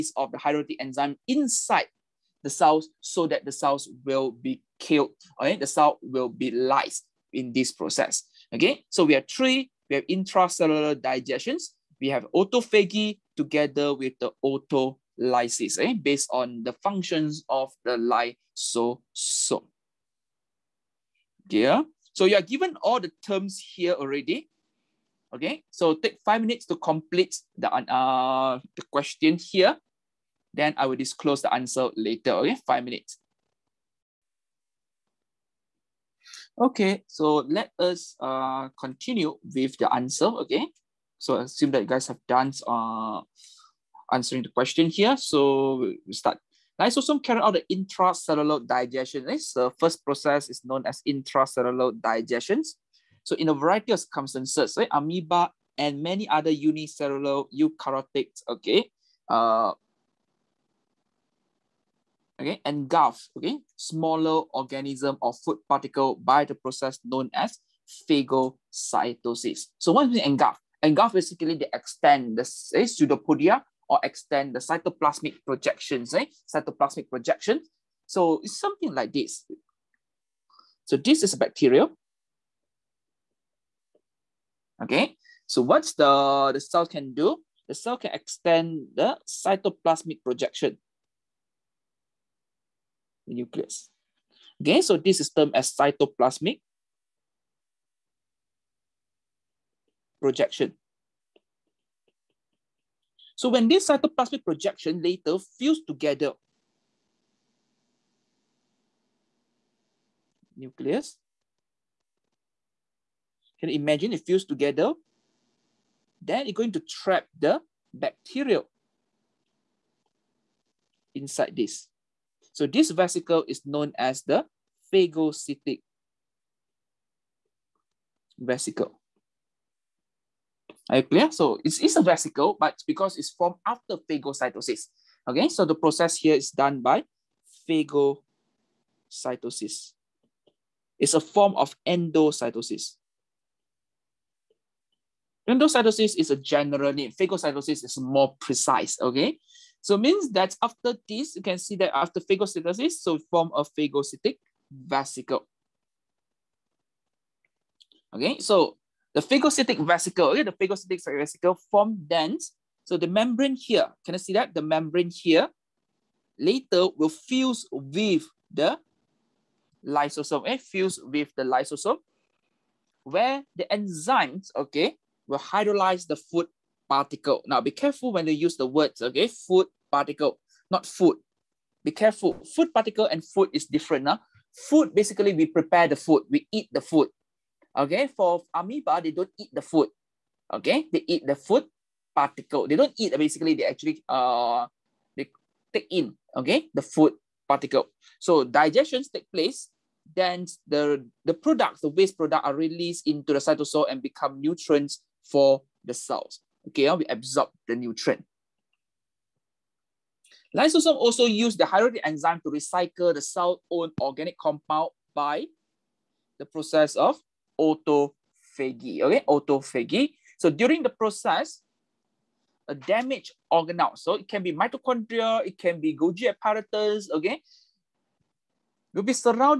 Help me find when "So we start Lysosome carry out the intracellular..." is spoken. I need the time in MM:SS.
00:45.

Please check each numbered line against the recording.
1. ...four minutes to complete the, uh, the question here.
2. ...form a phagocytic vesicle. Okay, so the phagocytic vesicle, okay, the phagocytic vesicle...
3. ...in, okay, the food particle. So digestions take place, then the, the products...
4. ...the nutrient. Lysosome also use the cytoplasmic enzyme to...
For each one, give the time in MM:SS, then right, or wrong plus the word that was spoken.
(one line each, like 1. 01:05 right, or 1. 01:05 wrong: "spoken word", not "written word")
1. 00:26 wrong: "five", not "four"
2. 02:33 right
3. 03:15 right
4. 03:27 wrong: "hydrolytic", not "cytoplasmic".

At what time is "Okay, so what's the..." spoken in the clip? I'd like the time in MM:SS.
01:24.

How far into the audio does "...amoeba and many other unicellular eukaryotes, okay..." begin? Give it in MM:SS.
00:54.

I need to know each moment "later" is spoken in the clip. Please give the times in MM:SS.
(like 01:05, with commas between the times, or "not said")
00:31, 01:45, 02:46.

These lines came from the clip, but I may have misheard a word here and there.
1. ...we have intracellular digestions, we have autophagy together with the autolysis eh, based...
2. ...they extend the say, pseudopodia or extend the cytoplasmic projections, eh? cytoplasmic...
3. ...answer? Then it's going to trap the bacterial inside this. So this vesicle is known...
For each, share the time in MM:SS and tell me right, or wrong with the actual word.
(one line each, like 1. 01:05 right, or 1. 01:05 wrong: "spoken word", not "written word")
1. 00:09 right
2. 01:11 right
3. 01:54 wrong: "together", not "answer".